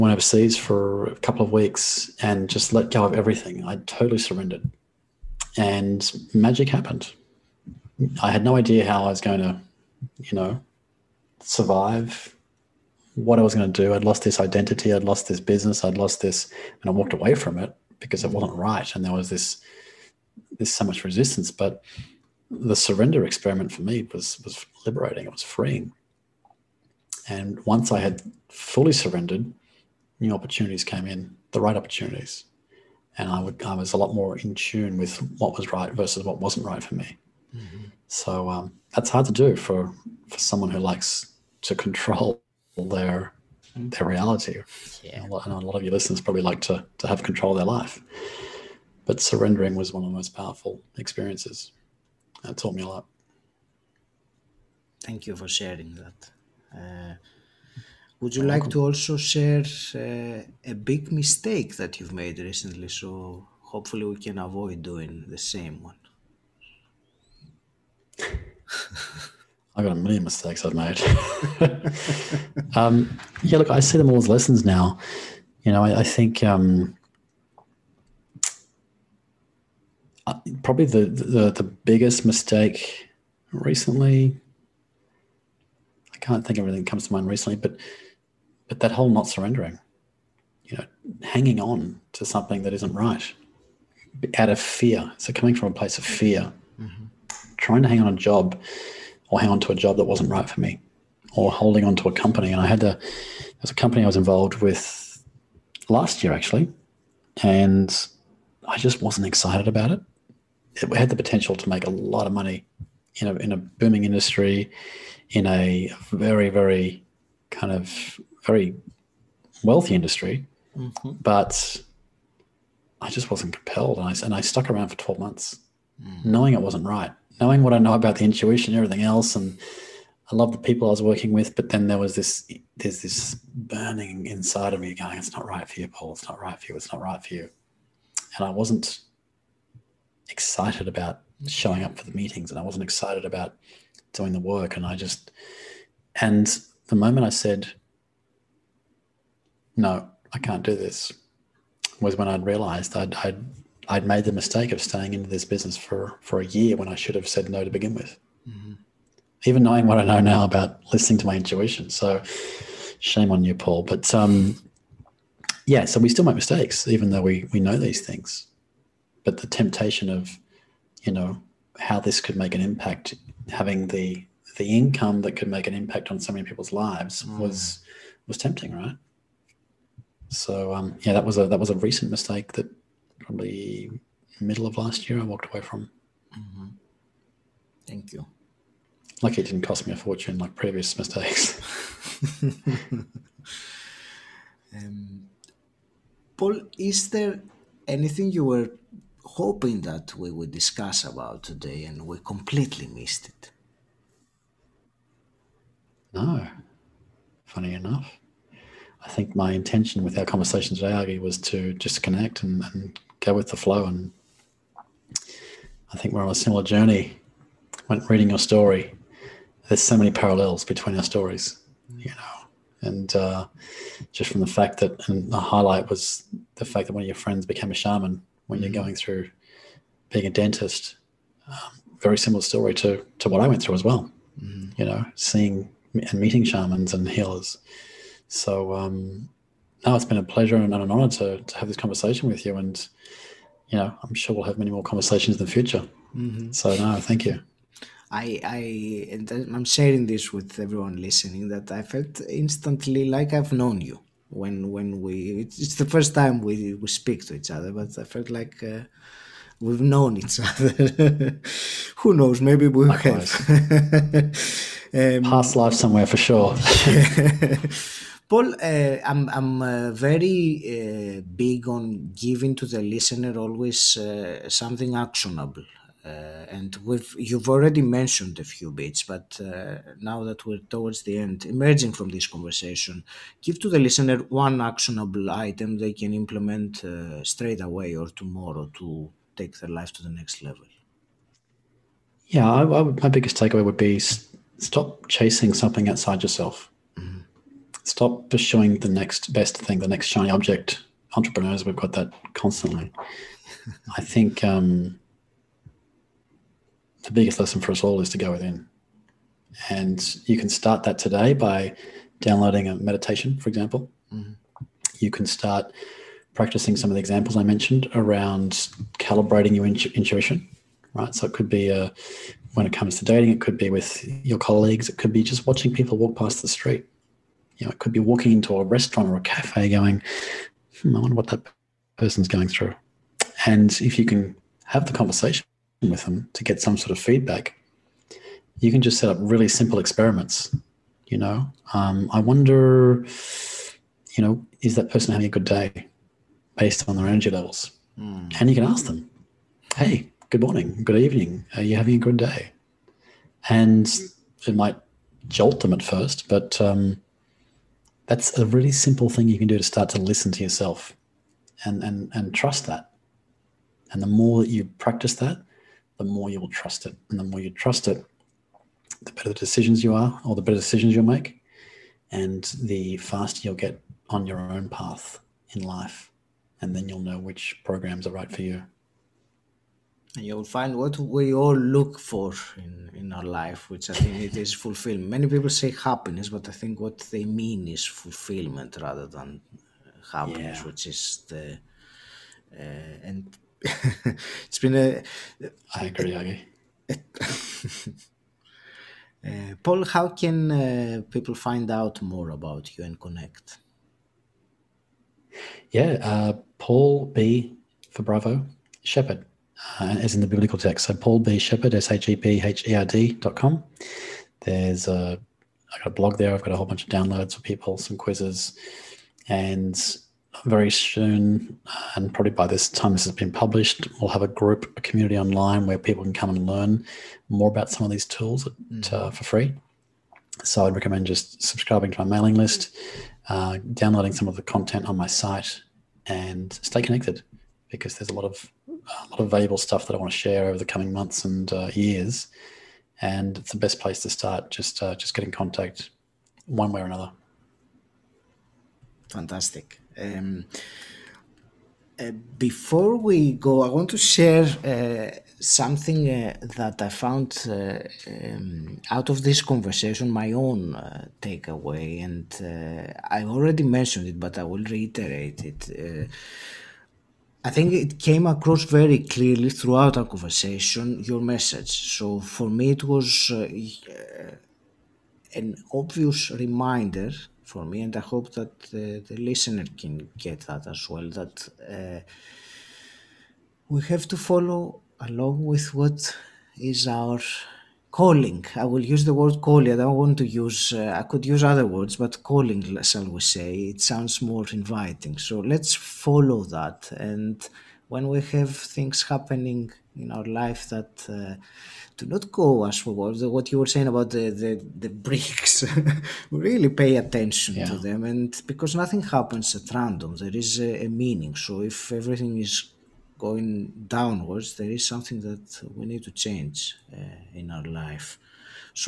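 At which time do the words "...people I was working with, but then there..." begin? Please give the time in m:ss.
2:10.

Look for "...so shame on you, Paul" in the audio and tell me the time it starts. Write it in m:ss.
2:41.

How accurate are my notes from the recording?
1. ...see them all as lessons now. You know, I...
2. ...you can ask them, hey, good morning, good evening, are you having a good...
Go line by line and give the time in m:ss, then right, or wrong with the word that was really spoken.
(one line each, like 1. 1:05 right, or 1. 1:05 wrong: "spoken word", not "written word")
1. 1:13 right
2. 5:48 right.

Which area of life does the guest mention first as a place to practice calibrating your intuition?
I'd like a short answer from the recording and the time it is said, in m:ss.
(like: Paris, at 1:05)
Dating, at 5:23.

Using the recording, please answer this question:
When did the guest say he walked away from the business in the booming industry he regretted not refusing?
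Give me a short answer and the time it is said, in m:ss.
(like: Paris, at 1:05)
Middle of last year, at 3:04.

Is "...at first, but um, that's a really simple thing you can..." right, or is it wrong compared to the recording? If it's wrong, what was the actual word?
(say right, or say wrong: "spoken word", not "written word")
right.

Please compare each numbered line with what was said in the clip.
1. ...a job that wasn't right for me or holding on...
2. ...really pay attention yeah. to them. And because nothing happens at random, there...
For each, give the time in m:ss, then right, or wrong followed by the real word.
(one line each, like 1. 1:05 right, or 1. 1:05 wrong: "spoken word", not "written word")
1. 1:39 right
2. 8:26 right.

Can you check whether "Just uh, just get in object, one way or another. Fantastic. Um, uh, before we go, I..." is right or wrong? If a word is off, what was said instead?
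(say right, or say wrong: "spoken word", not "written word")
wrong: "contact", not "object".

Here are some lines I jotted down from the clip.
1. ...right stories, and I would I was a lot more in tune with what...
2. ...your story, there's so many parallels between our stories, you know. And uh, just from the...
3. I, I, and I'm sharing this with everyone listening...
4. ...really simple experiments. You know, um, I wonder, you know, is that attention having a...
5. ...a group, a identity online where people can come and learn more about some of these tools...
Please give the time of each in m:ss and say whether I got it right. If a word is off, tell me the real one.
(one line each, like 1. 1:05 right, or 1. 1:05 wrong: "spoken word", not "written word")
1. 0:31 wrong: "opportunities", not "stories"
2. 3:38 right
3. 4:08 right
4. 5:39 wrong: "person", not "attention"
5. 7:04 wrong: "community", not "identity".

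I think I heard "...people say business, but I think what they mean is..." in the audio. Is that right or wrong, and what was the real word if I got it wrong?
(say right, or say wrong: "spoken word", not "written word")
wrong: "happiness", not "business".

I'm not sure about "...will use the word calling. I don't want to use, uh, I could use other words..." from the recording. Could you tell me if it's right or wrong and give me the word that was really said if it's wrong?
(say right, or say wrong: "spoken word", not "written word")
right.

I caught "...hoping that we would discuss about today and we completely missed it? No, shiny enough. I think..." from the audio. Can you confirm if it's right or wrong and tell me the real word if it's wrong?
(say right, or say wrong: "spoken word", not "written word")
wrong: "funny", not "shiny".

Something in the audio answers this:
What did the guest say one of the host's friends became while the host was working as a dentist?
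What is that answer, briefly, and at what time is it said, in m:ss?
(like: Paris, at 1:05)
A shaman, at 3:47.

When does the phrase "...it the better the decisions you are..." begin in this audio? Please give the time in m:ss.
6:07.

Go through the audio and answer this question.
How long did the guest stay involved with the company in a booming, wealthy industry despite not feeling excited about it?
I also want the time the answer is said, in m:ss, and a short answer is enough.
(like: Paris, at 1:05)
12 months, at 2:04.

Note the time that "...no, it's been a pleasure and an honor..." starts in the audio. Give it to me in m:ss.
3:59.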